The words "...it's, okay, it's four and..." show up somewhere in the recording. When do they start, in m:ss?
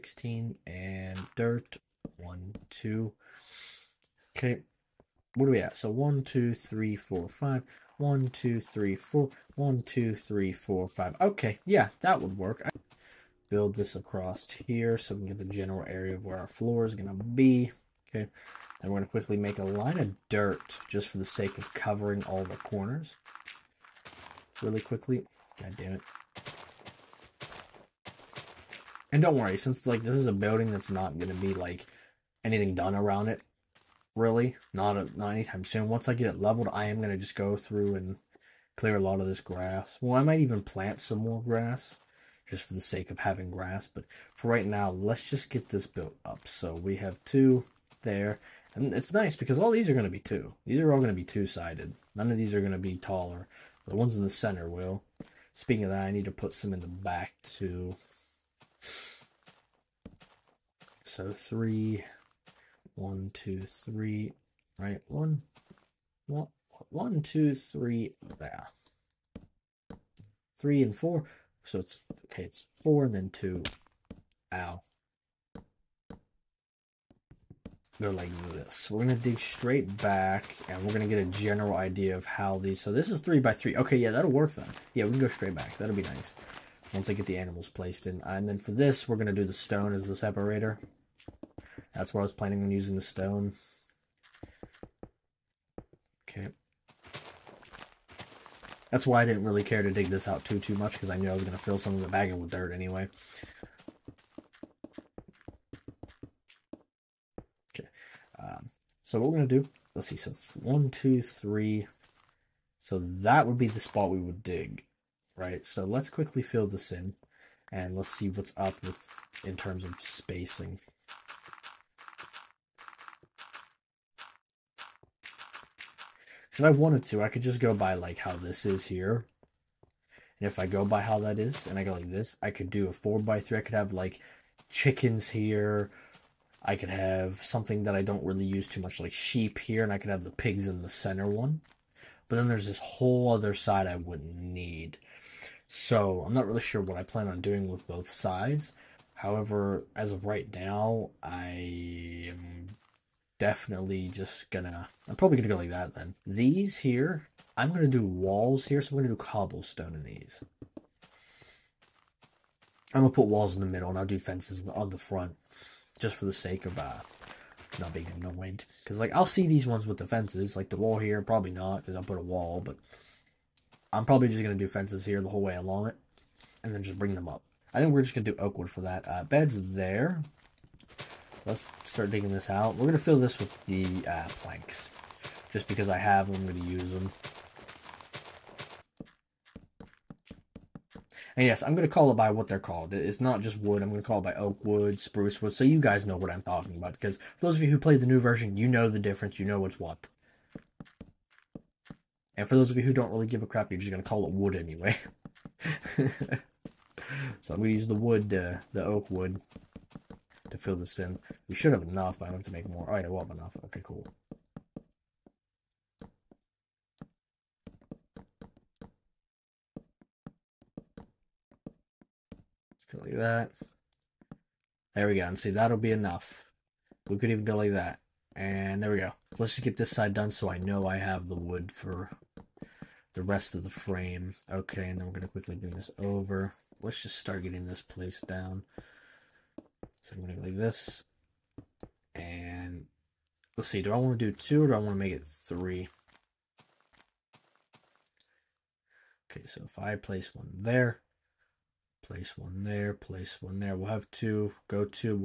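1:11.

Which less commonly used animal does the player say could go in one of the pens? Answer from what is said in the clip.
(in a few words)
Sheep.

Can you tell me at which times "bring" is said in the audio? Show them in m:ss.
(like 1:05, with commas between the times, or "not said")
2:56, 3:55.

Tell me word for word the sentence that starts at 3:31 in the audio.
We should have enough, but i don't have to make more.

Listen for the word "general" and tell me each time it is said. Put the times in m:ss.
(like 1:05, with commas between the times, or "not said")
0:15, 1:21.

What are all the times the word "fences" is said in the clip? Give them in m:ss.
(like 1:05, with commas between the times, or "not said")
2:44, 2:50, 2:54.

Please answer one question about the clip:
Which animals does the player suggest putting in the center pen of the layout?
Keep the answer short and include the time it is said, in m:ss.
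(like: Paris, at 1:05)
Pigs, at 2:20.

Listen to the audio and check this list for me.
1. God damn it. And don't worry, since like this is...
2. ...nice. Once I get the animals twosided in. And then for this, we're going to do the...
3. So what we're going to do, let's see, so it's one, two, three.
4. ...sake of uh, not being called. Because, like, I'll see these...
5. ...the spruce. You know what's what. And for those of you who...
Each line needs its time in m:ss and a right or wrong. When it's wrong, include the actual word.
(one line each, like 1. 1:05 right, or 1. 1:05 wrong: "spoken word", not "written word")
1. 0:25 right
2. 1:26 wrong: "placed", not "twosided"
3. 1:49 right
4. 2:46 wrong: "annoyed", not "called"
5. 3:18 wrong: "difference", not "spruce".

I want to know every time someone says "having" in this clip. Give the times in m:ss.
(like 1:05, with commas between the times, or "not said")
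0:43.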